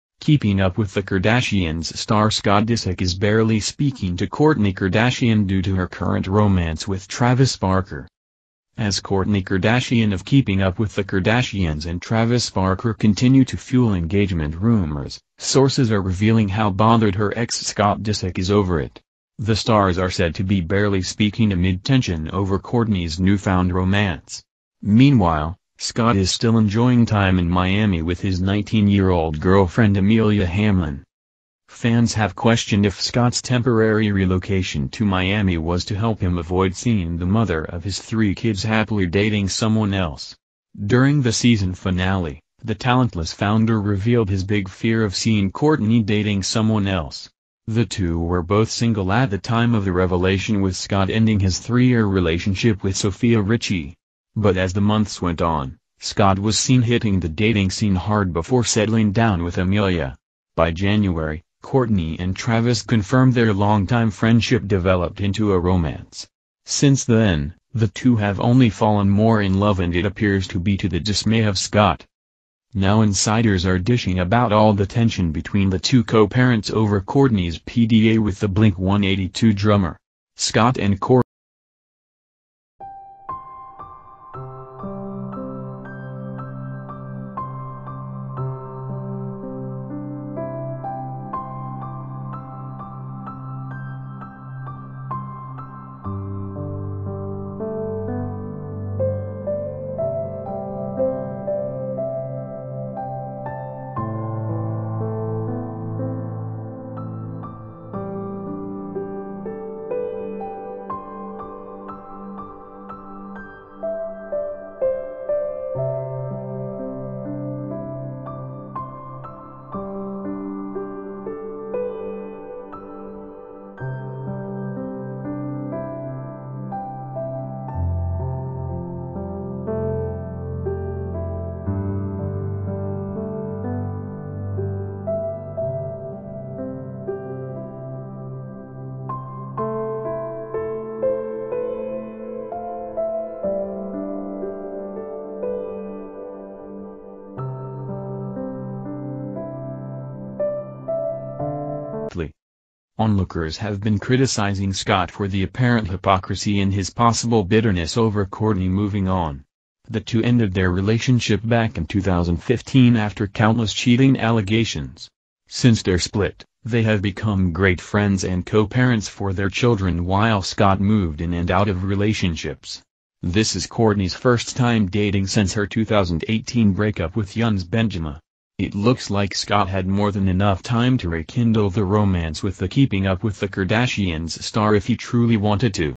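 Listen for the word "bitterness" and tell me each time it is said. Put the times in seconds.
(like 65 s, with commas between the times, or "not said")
157 s.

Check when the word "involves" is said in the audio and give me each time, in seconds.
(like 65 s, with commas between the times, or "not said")
not said.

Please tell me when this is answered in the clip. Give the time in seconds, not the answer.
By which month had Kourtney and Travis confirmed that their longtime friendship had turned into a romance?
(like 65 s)
60 s.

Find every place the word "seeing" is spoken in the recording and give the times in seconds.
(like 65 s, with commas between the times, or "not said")
36 s, 45 s.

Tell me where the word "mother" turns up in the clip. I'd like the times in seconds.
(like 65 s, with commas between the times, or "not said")
37 s.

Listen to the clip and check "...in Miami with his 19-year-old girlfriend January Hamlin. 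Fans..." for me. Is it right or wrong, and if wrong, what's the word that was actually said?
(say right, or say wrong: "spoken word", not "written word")
wrong: "Amelia", not "January".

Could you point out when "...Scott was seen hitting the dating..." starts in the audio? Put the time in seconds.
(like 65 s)
56 s.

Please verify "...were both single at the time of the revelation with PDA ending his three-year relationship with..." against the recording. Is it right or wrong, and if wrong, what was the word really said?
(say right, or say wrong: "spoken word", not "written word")
wrong: "Scott", not "PDA".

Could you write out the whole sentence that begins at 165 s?
Since their split, they have become great friends and co-parents for their children while Scott moved in and out of relationships.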